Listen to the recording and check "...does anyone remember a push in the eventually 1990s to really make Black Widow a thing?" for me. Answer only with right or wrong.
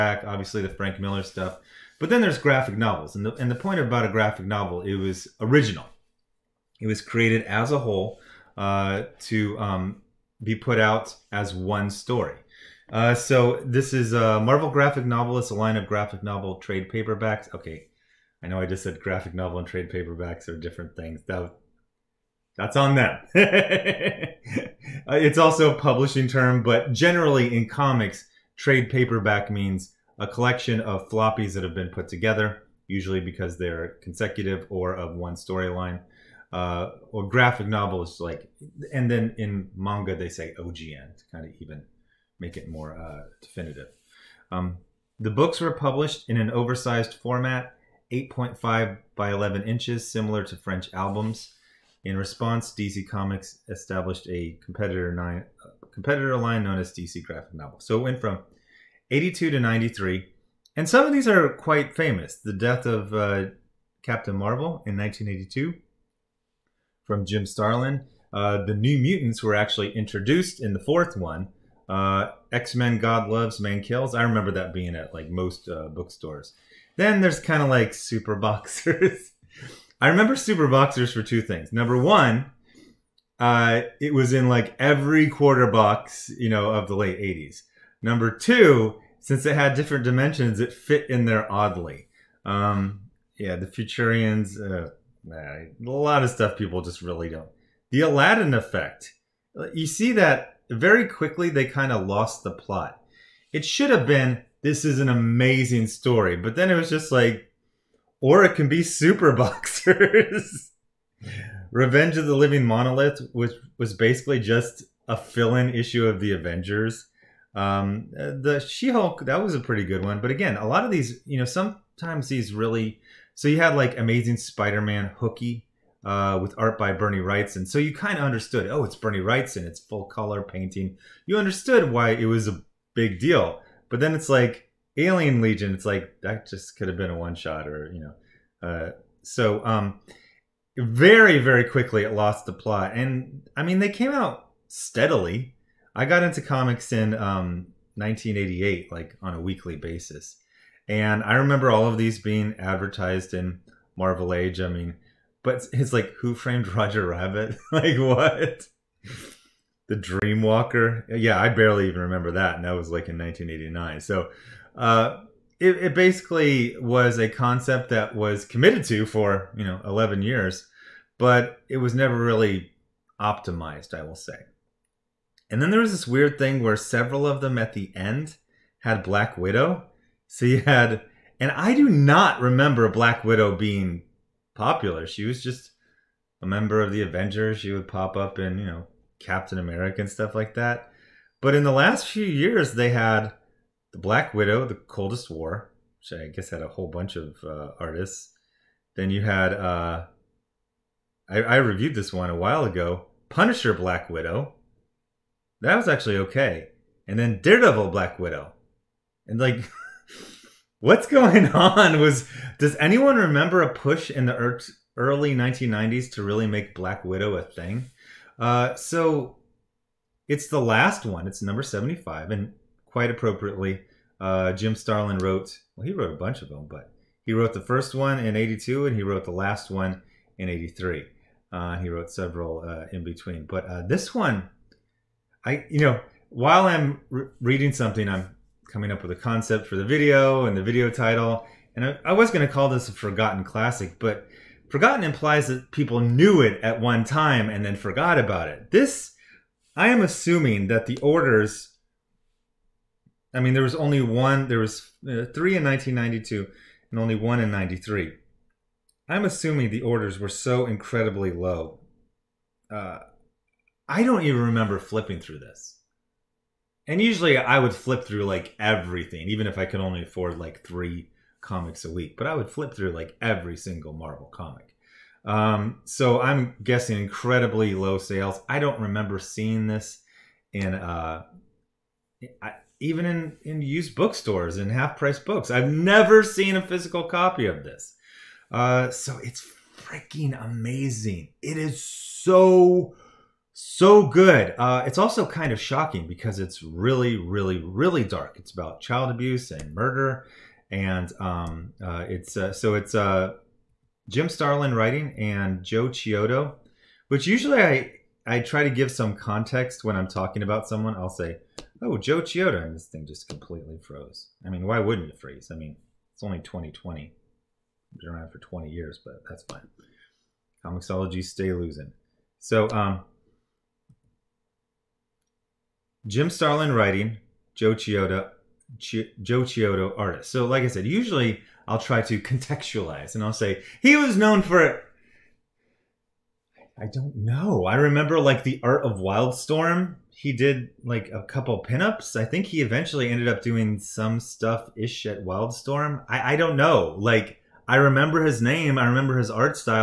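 wrong.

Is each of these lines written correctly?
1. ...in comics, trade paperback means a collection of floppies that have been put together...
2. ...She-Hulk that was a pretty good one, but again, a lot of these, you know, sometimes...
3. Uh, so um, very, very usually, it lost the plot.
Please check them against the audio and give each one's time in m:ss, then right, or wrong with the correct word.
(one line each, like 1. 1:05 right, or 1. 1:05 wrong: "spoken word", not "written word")
1. 0:27 right
2. 1:58 right
3. 2:18 wrong: "quickly", not "usually".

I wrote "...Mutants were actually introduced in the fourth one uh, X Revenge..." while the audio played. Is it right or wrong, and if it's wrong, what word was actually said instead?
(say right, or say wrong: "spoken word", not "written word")
wrong: "Men", not "Revenge".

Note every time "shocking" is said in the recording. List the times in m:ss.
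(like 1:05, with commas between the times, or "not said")
4:55.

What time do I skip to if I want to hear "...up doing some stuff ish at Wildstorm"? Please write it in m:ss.
5:43.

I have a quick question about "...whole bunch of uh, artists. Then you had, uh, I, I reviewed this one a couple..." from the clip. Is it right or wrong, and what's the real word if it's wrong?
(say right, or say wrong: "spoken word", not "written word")
wrong: "while", not "couple".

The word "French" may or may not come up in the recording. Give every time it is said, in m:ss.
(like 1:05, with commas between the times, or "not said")
0:50.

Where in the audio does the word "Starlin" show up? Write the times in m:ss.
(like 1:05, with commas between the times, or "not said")
1:07, 3:44, 5:04, 5:26.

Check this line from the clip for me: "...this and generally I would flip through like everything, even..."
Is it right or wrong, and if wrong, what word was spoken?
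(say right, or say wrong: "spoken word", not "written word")
wrong: "usually", not "generally".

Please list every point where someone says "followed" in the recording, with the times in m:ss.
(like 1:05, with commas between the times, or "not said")
not said.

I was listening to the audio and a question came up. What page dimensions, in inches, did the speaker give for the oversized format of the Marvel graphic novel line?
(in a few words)
8.5 by 11.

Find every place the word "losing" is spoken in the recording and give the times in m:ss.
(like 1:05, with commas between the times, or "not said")
5:21.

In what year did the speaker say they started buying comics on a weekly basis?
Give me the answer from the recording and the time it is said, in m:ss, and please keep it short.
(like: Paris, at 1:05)
1988, at 2:27.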